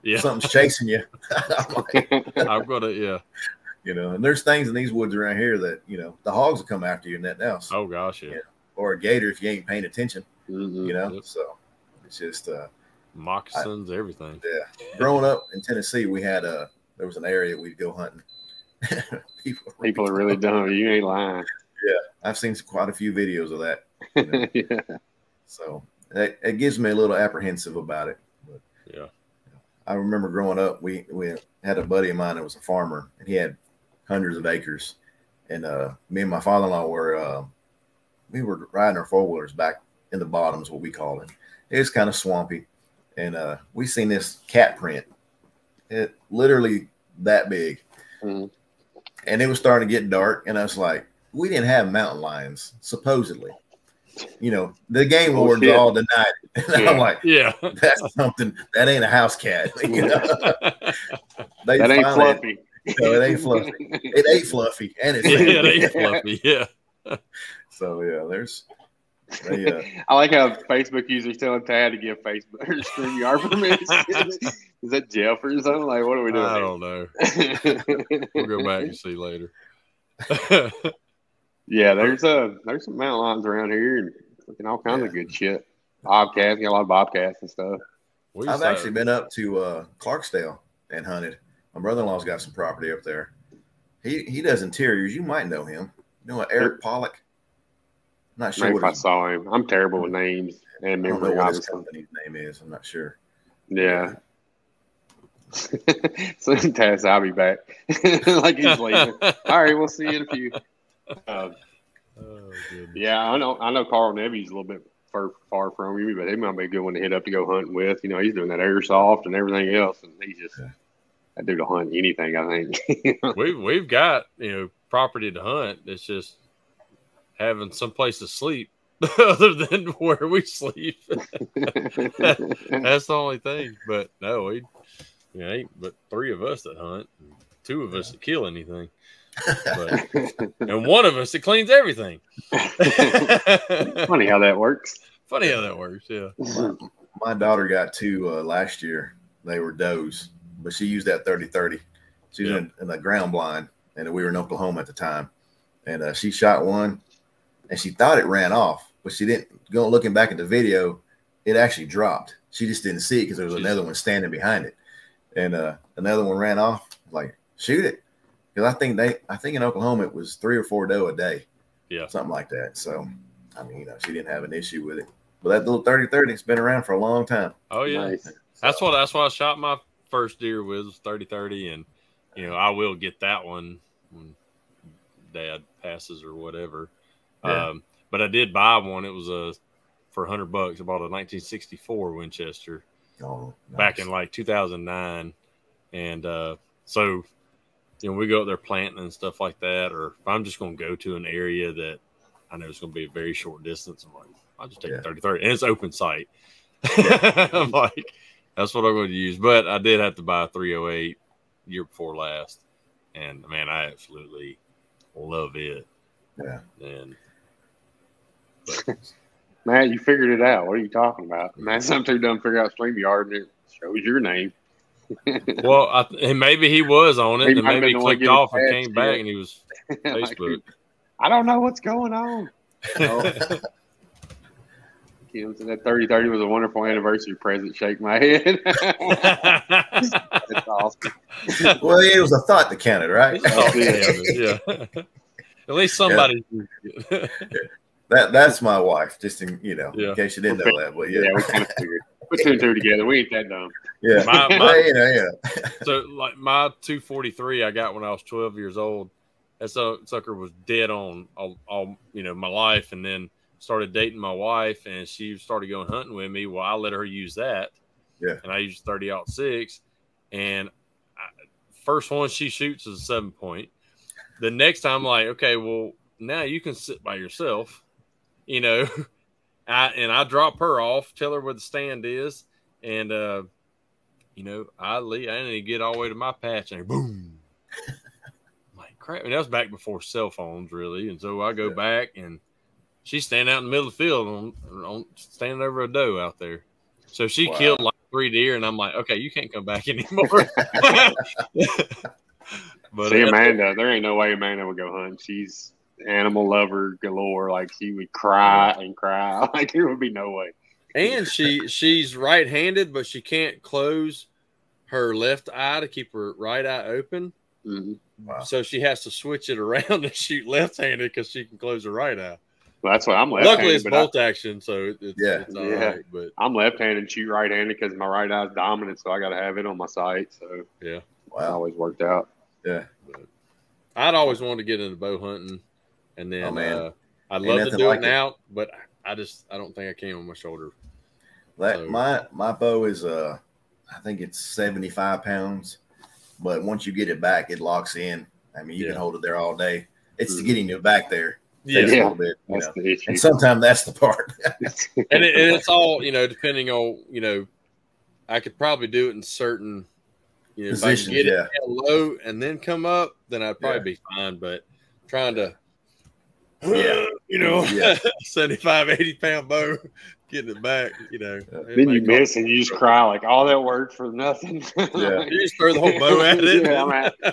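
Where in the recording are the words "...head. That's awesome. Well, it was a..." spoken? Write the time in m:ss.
3:58.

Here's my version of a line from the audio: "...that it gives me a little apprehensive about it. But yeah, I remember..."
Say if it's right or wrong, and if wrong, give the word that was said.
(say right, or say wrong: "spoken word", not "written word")
right.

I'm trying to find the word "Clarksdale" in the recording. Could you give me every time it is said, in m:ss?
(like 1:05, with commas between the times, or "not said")
1:29.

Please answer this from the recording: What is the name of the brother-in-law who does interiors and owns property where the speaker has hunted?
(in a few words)
Eric Pollock.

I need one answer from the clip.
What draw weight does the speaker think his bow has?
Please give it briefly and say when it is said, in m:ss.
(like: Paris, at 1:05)
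75 pounds, at 5:44.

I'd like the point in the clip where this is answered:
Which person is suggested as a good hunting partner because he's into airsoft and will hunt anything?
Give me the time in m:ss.
1:53.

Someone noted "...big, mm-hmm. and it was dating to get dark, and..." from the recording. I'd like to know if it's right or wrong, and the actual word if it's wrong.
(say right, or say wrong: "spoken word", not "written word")
wrong: "starting", not "dating".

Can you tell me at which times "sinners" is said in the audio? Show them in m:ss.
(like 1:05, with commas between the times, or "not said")
not said.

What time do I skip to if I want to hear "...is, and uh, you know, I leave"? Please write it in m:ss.
4:42.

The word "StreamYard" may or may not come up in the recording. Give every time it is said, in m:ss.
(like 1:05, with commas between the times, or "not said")
1:12, 3:42.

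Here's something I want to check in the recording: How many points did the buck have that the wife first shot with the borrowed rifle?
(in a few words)
seven point.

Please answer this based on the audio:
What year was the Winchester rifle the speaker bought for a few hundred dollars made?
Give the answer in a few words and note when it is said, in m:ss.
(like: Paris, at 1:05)
1964, at 3:11.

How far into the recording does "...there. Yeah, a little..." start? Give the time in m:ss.
5:51.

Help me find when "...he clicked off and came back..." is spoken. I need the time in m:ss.
3:47.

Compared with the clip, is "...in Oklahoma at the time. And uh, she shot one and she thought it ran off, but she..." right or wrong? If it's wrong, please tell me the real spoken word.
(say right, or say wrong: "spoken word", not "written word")
right.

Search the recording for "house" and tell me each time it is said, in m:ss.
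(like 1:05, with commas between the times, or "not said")
0:07, 0:59.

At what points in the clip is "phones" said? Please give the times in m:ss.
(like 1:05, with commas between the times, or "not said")
4:50.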